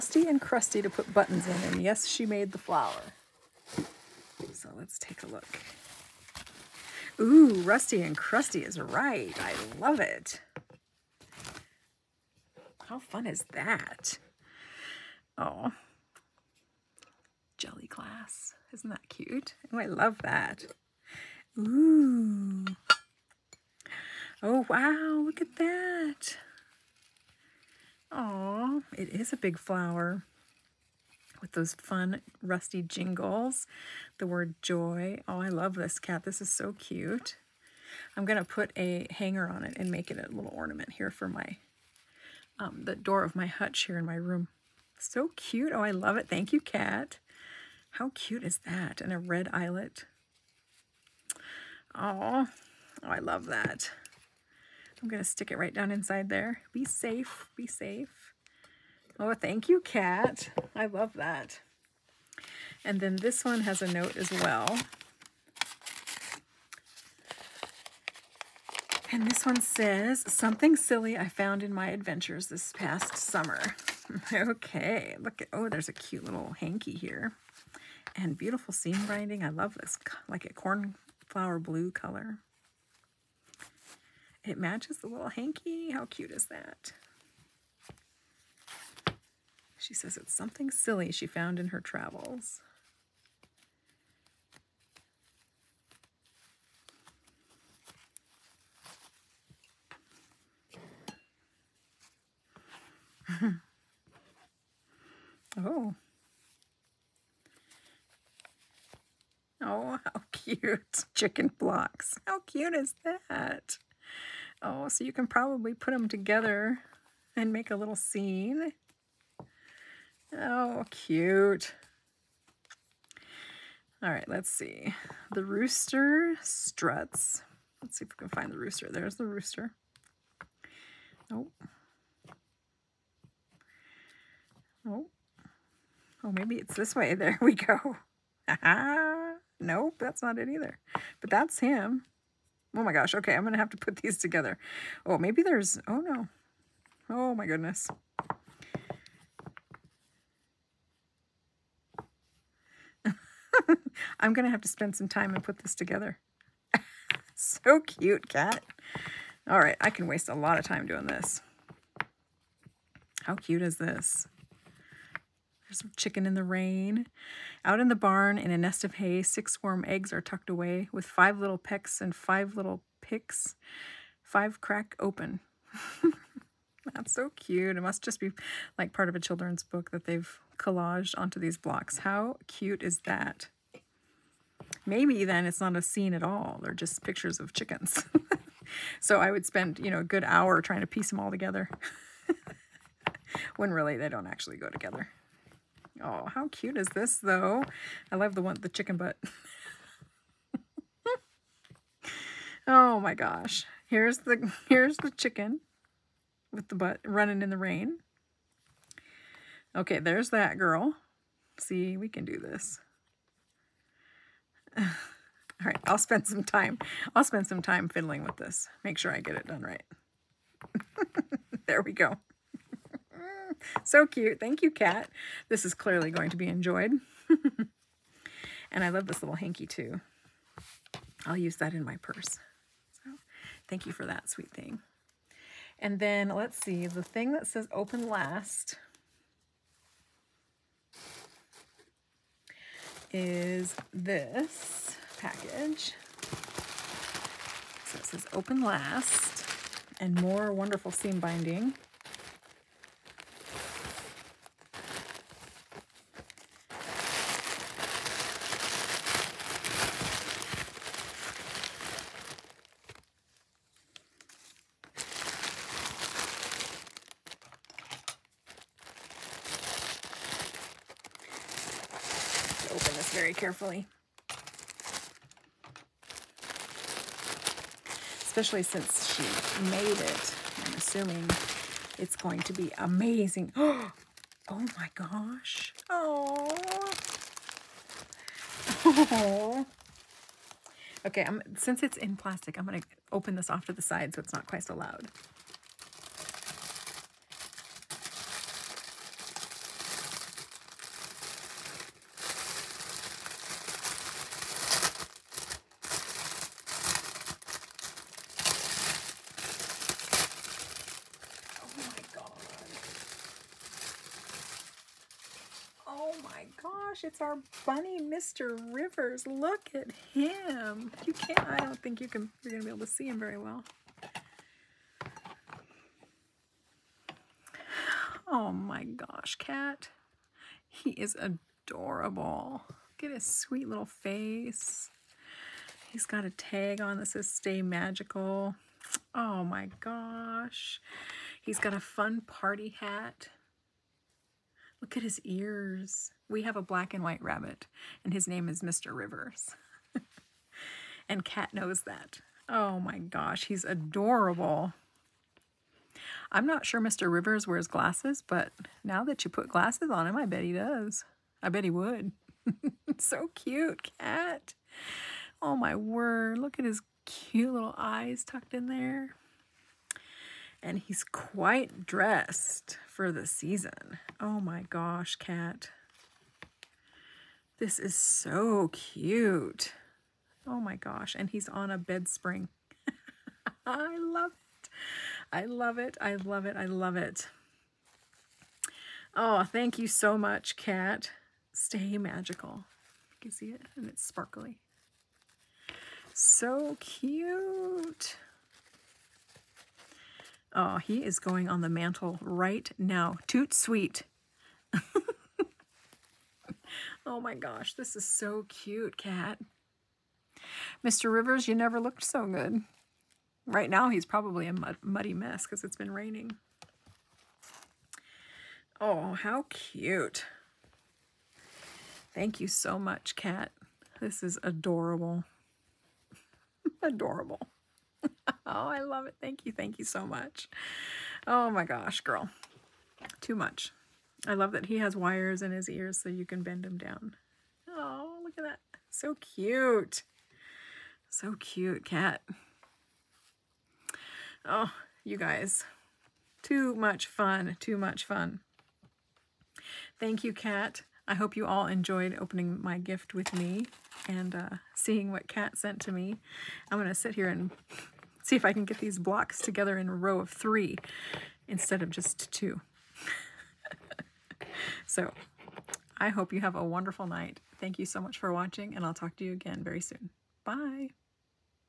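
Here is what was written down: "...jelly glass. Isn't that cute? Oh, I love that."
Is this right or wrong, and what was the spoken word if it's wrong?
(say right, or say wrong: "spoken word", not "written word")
right.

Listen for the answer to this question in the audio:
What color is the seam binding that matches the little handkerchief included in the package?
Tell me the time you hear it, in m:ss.
1:20.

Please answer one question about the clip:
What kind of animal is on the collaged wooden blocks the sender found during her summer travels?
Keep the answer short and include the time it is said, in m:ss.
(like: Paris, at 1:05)
Chickens, at 1:51.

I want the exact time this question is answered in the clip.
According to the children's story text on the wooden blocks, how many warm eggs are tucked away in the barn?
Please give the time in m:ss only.
2:49.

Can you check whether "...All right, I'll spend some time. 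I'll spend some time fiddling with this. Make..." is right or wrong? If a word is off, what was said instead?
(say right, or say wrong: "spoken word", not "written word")
right.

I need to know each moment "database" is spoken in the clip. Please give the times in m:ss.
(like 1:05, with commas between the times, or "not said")
not said.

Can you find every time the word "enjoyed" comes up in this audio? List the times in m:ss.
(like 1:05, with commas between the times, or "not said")
3:46, 7:31.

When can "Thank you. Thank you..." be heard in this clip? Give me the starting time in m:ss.
7:09.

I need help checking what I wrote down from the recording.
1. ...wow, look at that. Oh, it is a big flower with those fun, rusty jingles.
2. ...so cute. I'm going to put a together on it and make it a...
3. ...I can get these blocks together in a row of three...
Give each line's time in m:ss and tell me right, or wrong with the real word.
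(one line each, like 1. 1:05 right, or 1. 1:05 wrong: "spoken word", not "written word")
1. 0:24 right
2. 0:36 wrong: "hanger", not "together"
3. 7:38 right.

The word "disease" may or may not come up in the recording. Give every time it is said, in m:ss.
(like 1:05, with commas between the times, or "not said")
not said.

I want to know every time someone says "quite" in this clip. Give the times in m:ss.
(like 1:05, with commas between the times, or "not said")
4:54, 6:11.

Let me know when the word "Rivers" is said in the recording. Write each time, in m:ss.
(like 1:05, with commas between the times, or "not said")
5:18, 5:48, 5:57, 6:51.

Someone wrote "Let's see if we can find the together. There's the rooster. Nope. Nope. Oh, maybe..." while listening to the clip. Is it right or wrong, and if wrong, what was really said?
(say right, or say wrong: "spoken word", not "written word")
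wrong: "rooster", not "together".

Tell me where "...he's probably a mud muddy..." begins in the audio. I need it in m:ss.
6:53.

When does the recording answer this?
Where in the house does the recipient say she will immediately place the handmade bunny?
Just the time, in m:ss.
6:41.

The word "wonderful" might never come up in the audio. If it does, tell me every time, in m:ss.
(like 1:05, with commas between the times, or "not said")
4:10, 7:46.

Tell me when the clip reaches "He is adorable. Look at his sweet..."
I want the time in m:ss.
5:30.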